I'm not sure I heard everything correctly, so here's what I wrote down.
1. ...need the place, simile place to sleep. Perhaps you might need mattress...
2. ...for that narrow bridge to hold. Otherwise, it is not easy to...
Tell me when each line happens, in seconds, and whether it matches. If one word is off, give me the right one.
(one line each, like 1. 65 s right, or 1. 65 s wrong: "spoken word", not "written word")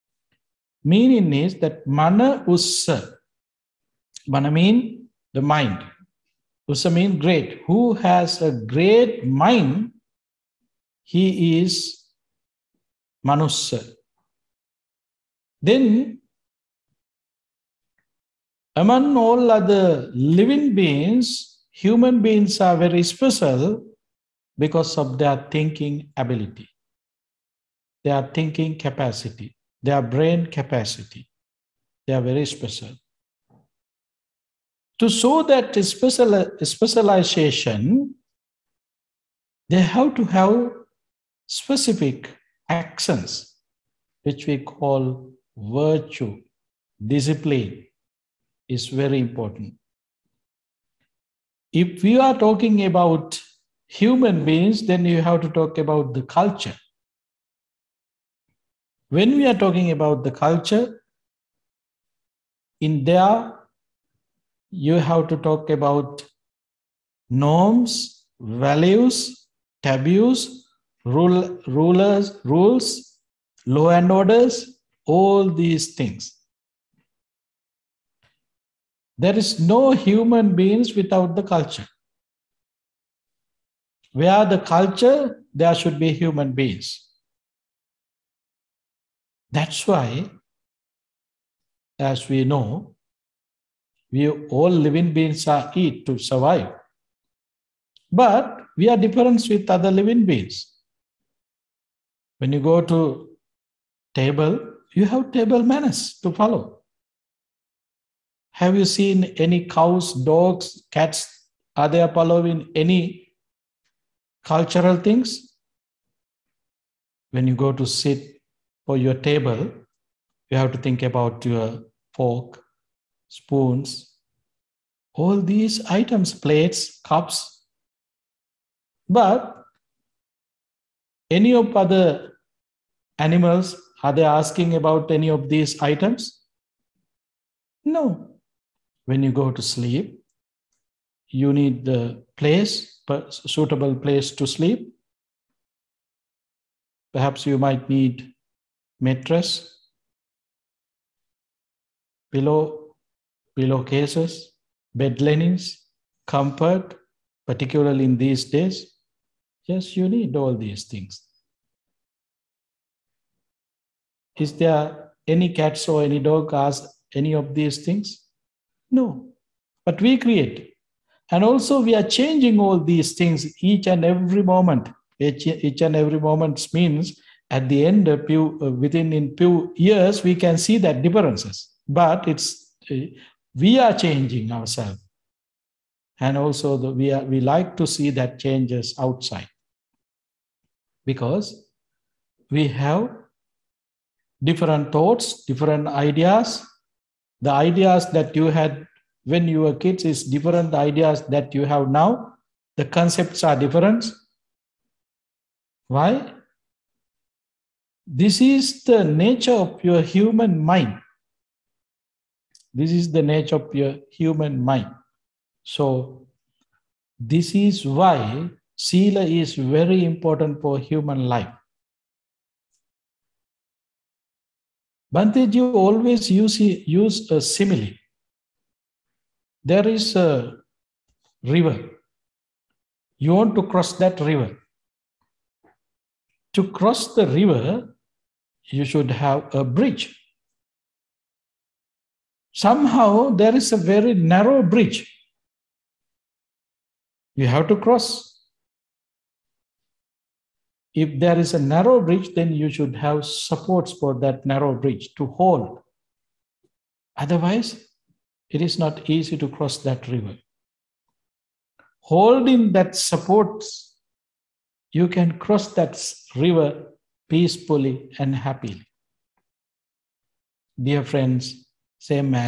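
1. 141 s wrong: "suitable", not "simile"
2. 253 s right.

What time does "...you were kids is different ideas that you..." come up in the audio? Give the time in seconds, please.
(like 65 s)
199 s.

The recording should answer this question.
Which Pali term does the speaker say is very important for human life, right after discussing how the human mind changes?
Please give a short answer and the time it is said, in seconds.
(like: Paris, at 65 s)
Sila, at 218 s.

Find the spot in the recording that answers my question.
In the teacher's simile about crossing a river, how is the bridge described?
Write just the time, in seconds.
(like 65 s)
243 s.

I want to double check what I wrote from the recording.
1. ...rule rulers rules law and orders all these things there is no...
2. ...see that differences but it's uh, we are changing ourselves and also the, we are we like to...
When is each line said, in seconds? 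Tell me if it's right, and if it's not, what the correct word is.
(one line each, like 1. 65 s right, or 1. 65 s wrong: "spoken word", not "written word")
1. 71 s right
2. 180 s right.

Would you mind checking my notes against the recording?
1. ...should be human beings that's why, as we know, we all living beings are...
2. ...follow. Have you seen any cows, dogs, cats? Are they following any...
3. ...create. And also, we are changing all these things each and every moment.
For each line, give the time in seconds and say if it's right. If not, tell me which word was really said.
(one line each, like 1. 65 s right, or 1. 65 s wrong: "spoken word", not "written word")
1. 85 s right
2. 106 s right
3. 170 s right.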